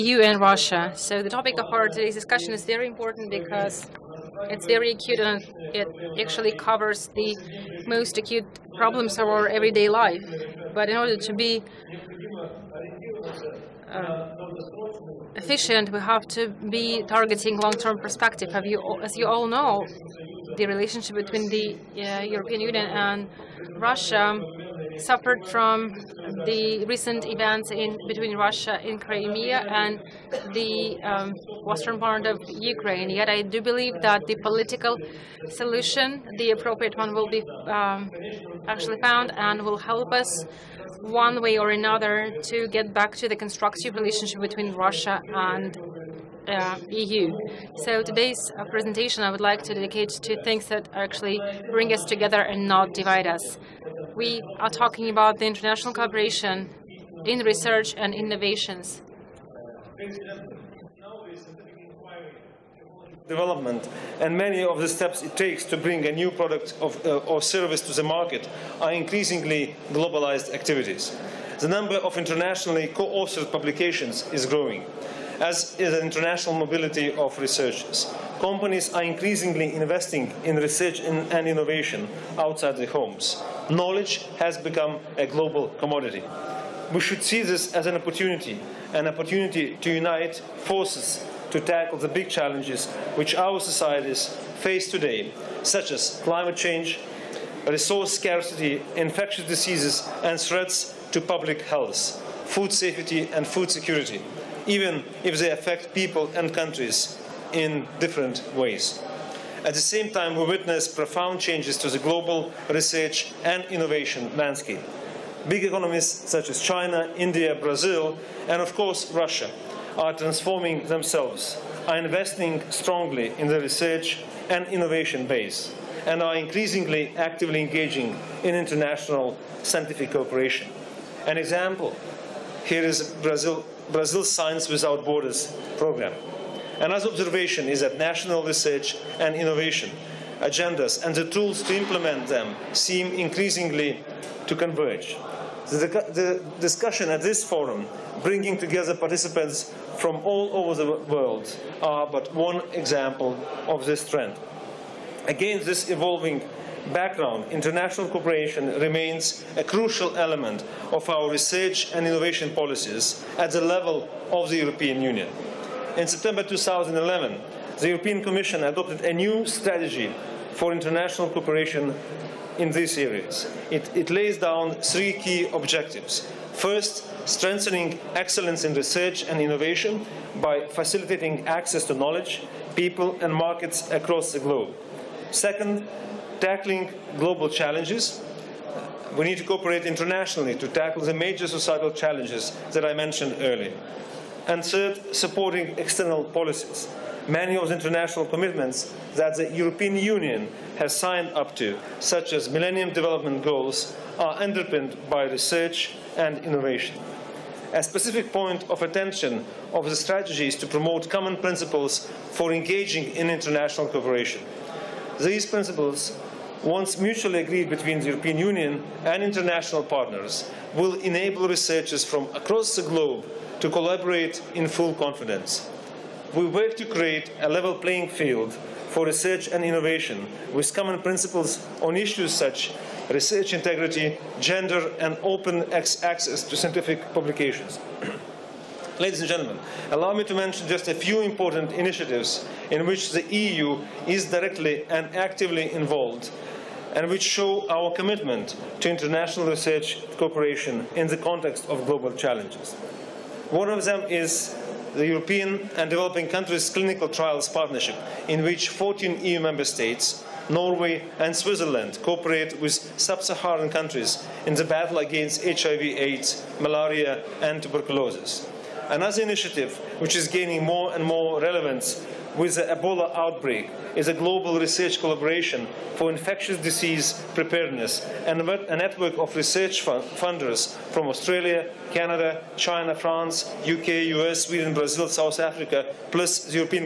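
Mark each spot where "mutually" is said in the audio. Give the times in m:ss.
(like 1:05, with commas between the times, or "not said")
3:36.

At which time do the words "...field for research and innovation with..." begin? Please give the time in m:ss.
3:48.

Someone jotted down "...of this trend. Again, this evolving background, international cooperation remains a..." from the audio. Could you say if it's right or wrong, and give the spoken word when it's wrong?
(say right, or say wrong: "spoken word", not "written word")
right.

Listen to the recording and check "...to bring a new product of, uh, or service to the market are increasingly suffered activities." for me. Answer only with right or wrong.
wrong.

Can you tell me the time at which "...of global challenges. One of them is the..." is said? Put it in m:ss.
4:11.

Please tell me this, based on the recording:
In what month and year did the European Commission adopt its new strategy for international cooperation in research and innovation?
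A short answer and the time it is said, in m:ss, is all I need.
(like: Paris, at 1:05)
September 2011, at 2:46.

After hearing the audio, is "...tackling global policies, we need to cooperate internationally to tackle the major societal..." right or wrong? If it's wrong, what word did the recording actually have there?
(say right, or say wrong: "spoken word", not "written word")
wrong: "challenges", not "policies".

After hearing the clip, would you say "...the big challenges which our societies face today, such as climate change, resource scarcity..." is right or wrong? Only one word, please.
right.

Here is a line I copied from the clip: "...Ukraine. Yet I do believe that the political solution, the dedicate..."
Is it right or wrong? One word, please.
wrong.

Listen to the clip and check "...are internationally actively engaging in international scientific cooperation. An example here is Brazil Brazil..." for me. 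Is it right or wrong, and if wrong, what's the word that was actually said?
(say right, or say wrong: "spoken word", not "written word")
wrong: "increasingly", not "internationally".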